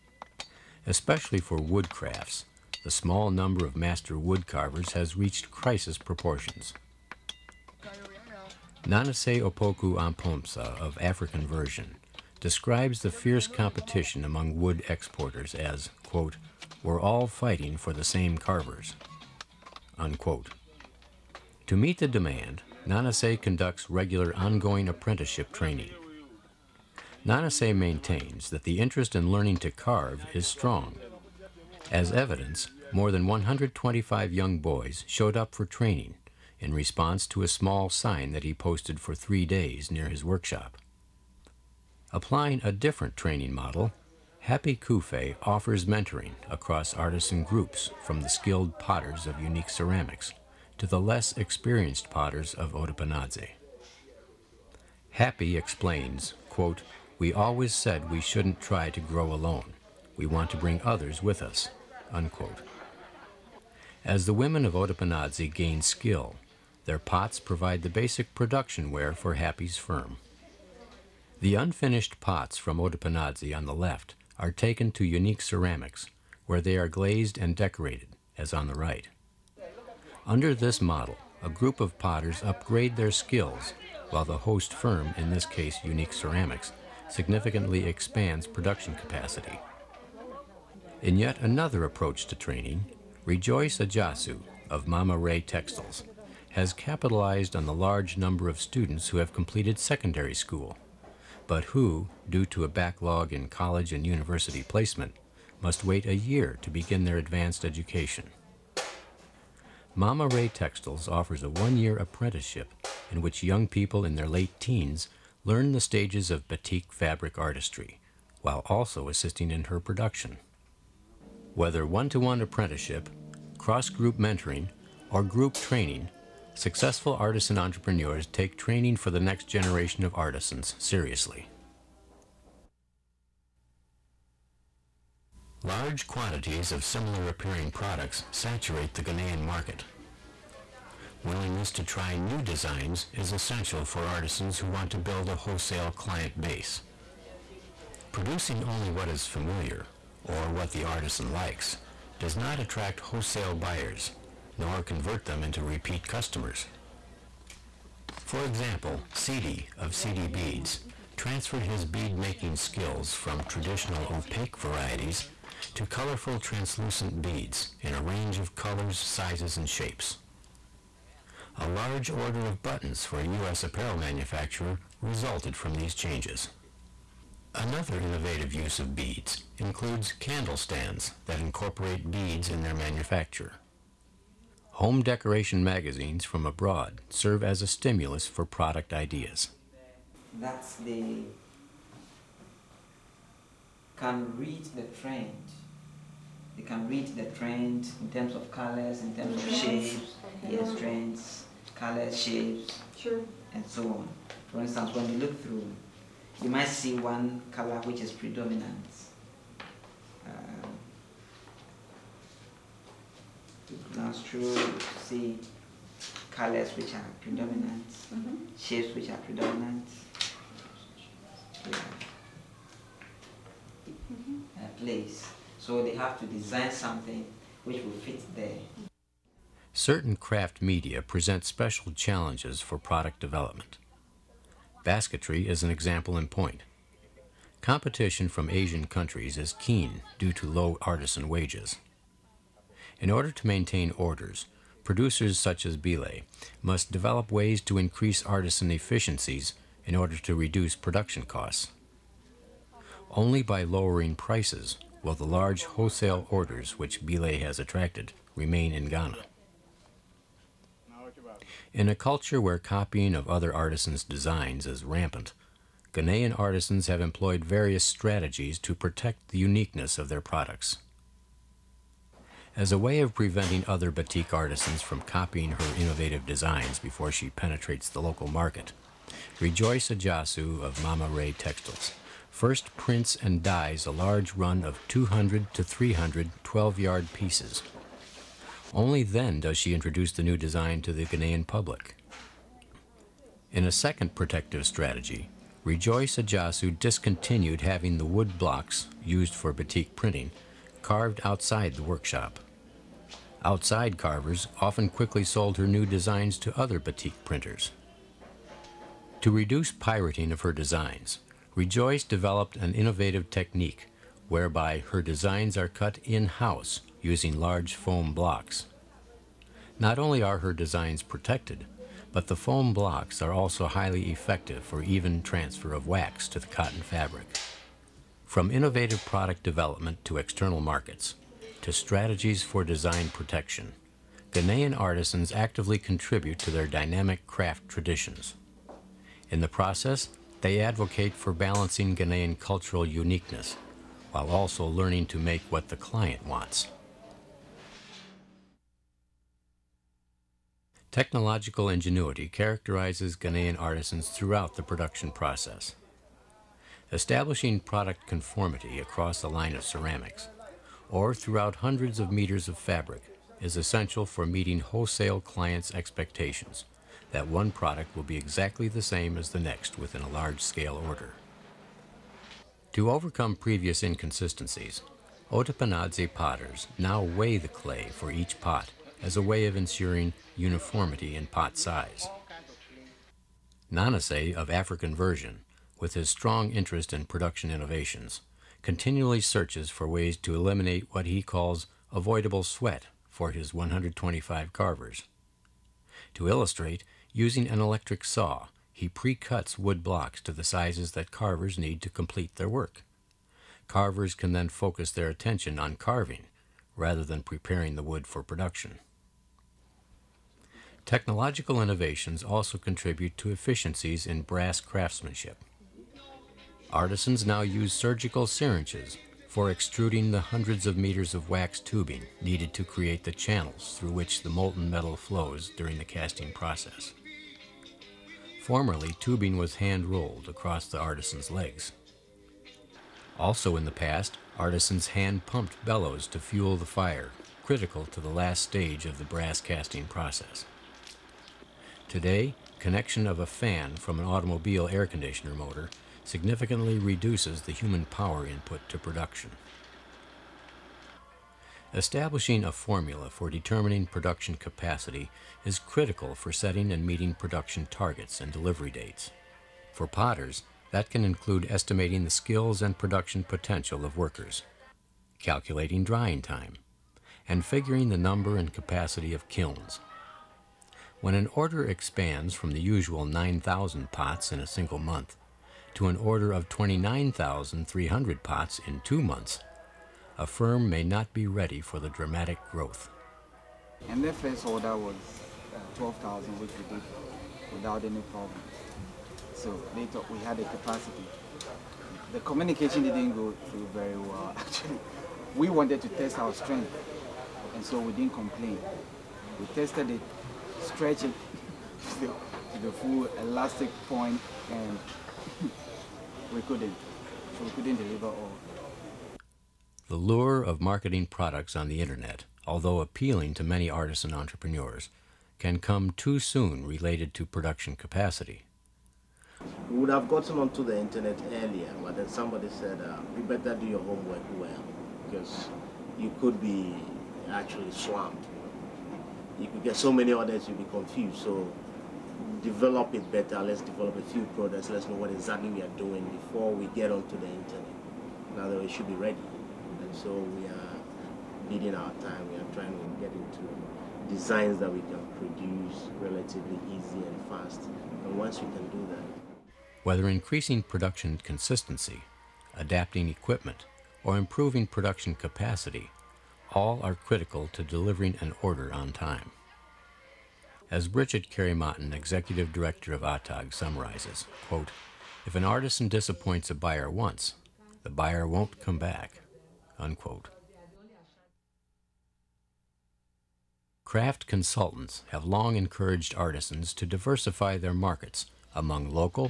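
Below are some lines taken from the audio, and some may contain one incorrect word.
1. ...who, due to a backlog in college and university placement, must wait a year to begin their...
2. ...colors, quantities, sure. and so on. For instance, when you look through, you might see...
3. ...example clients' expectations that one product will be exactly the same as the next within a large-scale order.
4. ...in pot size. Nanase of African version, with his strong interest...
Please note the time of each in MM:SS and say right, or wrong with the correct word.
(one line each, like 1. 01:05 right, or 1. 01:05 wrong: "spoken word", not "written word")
1. 01:41 right
2. 03:21 wrong: "shapes", not "quantities"
3. 06:04 wrong: "wholesale", not "example"
4. 06:21 right.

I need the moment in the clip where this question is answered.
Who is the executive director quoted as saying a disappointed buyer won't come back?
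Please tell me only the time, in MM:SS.
09:20.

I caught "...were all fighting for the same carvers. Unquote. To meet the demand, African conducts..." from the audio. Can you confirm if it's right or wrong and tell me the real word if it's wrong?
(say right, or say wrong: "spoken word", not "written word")
wrong: "Nanase", not "African".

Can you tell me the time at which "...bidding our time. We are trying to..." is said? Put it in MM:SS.
09:01.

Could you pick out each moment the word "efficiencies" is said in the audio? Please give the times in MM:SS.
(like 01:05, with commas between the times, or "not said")
04:08, 06:53.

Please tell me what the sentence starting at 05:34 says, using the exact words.
Ghanaian artisans actively contribute to their dynamic craft traditions.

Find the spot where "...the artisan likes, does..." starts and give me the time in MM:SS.
02:30.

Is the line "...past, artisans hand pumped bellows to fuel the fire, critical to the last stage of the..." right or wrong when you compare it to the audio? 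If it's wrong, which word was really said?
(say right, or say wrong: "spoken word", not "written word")
right.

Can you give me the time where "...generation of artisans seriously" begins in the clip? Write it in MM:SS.
02:09.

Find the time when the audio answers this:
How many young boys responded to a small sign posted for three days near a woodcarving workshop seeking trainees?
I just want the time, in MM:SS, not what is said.
00:32.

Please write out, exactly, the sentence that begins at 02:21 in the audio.
Willingness to try new designs is essential for artisans who want to build a wholesale client base.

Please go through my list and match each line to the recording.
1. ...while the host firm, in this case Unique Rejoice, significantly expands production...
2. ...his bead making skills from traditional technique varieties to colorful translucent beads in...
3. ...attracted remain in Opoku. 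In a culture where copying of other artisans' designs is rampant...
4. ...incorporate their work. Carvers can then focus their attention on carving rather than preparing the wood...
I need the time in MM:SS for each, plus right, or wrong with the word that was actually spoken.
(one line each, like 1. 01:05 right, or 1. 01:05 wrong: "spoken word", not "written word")
1. 01:24 wrong: "Ceramics", not "Rejoice"
2. 02:41 wrong: "opaque", not "technique"
3. 04:17 wrong: "Ghana", not "Opoku"
4. 06:41 wrong: "complete", not "incorporate".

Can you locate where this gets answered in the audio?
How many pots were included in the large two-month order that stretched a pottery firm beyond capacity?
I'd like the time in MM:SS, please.
07:56.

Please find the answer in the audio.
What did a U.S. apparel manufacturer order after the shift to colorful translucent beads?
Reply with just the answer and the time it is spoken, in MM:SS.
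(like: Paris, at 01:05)
Buttons, at 02:52.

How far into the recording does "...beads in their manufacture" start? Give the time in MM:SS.
03:02.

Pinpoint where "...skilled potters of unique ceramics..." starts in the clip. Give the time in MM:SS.
00:48.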